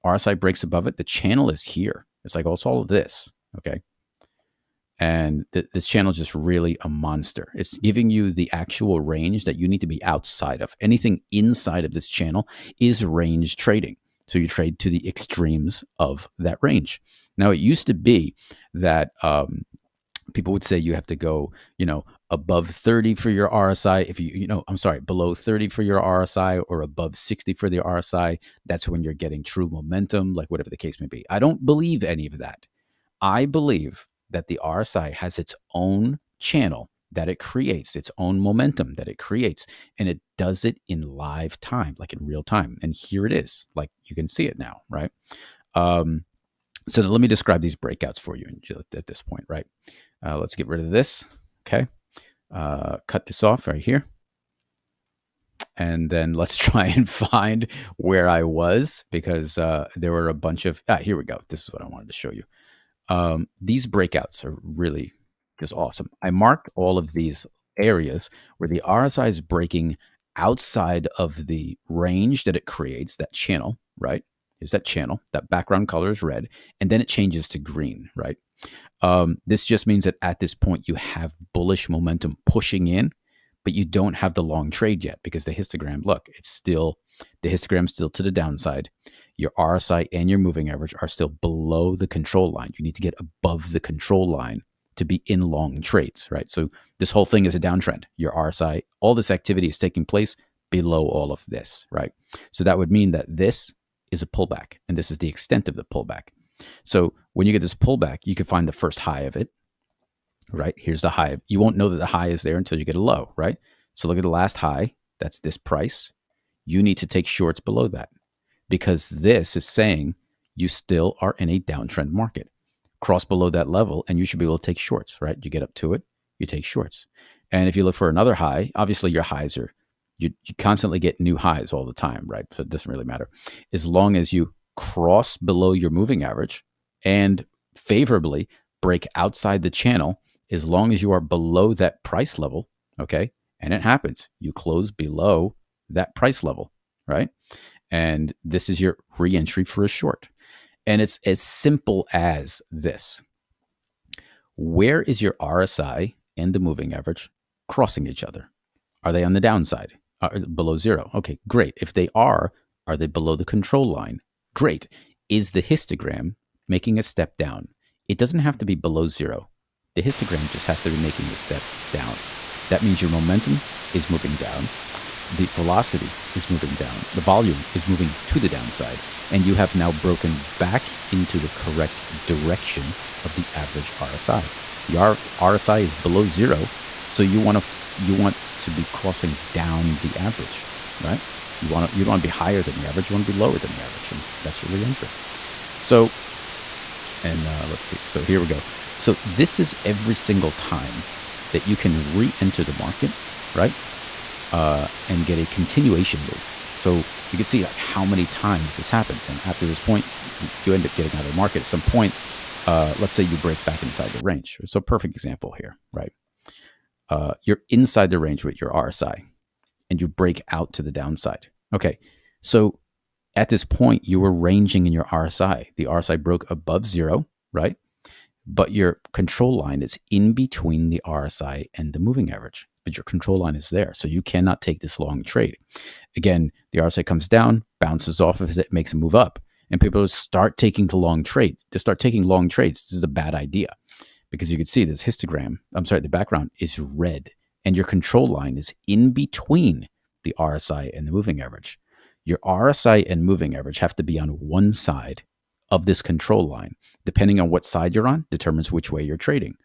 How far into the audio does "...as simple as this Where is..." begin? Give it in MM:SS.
02:31.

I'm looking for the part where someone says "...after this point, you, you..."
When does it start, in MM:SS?
03:29.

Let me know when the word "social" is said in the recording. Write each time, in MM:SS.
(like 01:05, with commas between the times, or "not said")
not said.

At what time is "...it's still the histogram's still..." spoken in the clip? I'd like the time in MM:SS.
01:26.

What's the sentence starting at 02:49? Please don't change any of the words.
The histogram just has to be making a step down.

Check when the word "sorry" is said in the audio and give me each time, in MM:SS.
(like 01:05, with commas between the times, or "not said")
00:24, 04:05.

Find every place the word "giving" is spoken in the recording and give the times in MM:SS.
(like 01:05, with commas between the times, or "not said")
00:07.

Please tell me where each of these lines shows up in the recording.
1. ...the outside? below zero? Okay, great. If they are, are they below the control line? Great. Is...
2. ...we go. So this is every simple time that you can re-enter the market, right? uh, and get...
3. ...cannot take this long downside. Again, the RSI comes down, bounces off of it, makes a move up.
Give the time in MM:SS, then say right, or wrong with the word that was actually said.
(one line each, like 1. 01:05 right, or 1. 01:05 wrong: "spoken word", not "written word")
1. 02:39 wrong: "downside", not "outside"
2. 03:18 wrong: "single", not "simple"
3. 03:54 wrong: "trade", not "downside".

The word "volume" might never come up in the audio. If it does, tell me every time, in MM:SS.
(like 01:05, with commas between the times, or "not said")
02:57.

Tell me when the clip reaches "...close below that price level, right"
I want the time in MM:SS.
02:24.